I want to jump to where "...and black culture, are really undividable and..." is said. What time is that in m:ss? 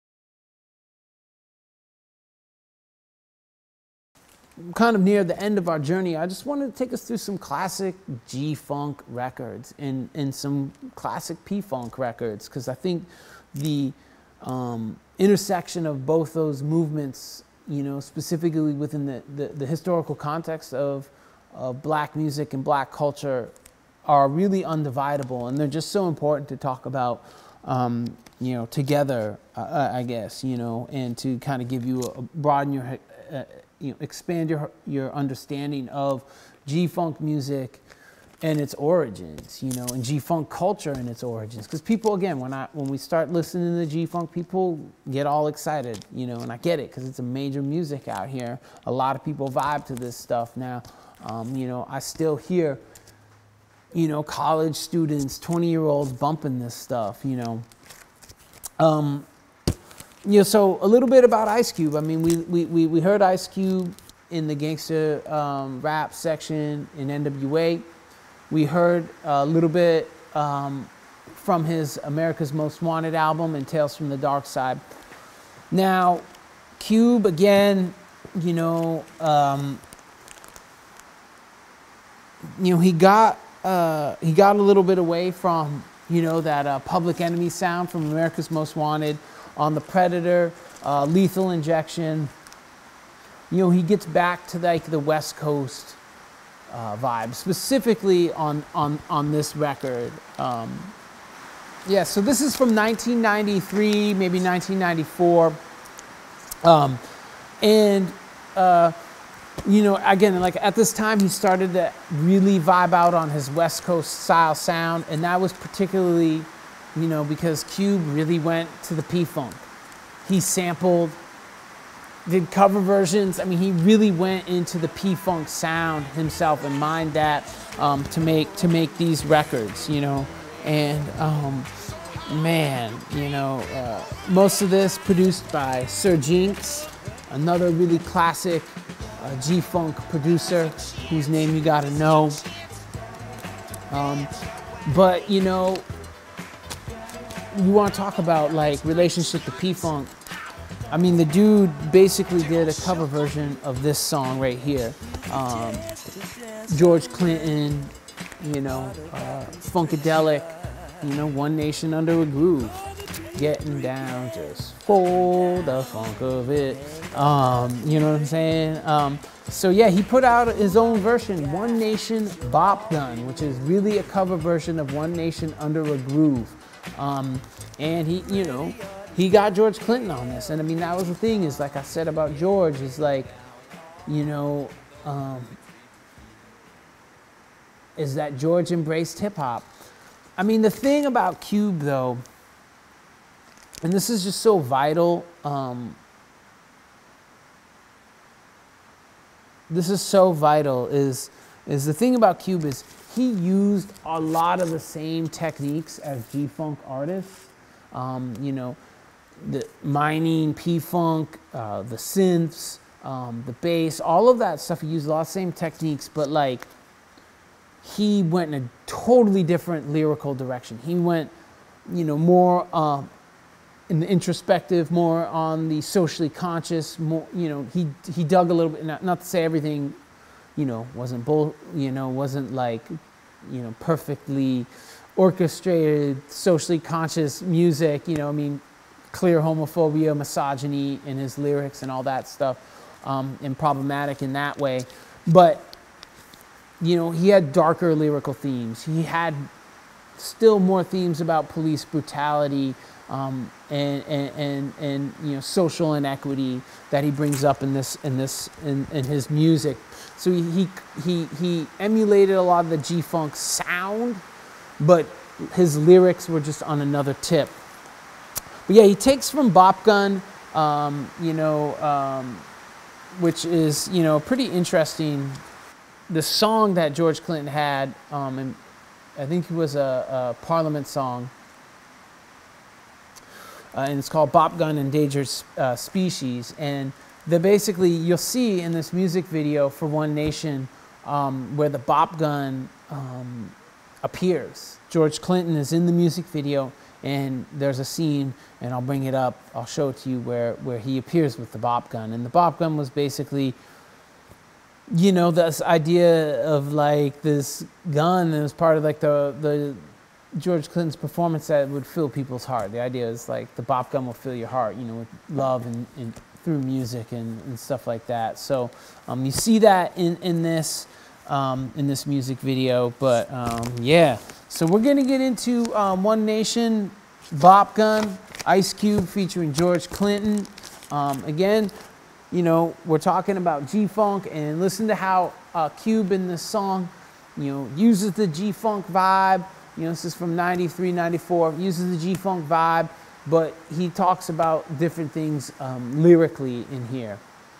0:22.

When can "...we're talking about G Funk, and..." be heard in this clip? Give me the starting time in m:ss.
5:32.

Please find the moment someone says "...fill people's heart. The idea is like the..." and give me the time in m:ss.
5:11.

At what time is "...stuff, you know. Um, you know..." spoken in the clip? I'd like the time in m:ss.
0:56.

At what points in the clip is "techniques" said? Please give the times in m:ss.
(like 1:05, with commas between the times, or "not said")
3:25, 3:35.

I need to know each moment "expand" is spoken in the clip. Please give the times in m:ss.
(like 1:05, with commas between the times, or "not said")
0:33.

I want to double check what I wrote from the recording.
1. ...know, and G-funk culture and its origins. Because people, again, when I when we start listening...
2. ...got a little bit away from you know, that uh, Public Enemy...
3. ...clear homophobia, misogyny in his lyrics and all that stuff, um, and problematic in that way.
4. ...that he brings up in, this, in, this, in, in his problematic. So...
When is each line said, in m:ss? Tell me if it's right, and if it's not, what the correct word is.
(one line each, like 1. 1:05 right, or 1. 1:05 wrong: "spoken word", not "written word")
1. 0:39 right
2. 1:24 right
3. 3:59 right
4. 4:16 wrong: "music", not "problematic".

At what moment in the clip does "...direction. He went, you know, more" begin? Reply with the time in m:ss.
3:40.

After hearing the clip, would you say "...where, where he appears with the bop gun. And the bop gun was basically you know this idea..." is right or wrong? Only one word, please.
right.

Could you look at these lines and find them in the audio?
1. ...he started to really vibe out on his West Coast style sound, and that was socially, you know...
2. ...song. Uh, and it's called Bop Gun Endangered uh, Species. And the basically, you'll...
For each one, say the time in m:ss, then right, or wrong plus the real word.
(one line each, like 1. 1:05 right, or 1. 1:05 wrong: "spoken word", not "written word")
1. 1:51 wrong: "particularly", not "socially"
2. 4:40 right.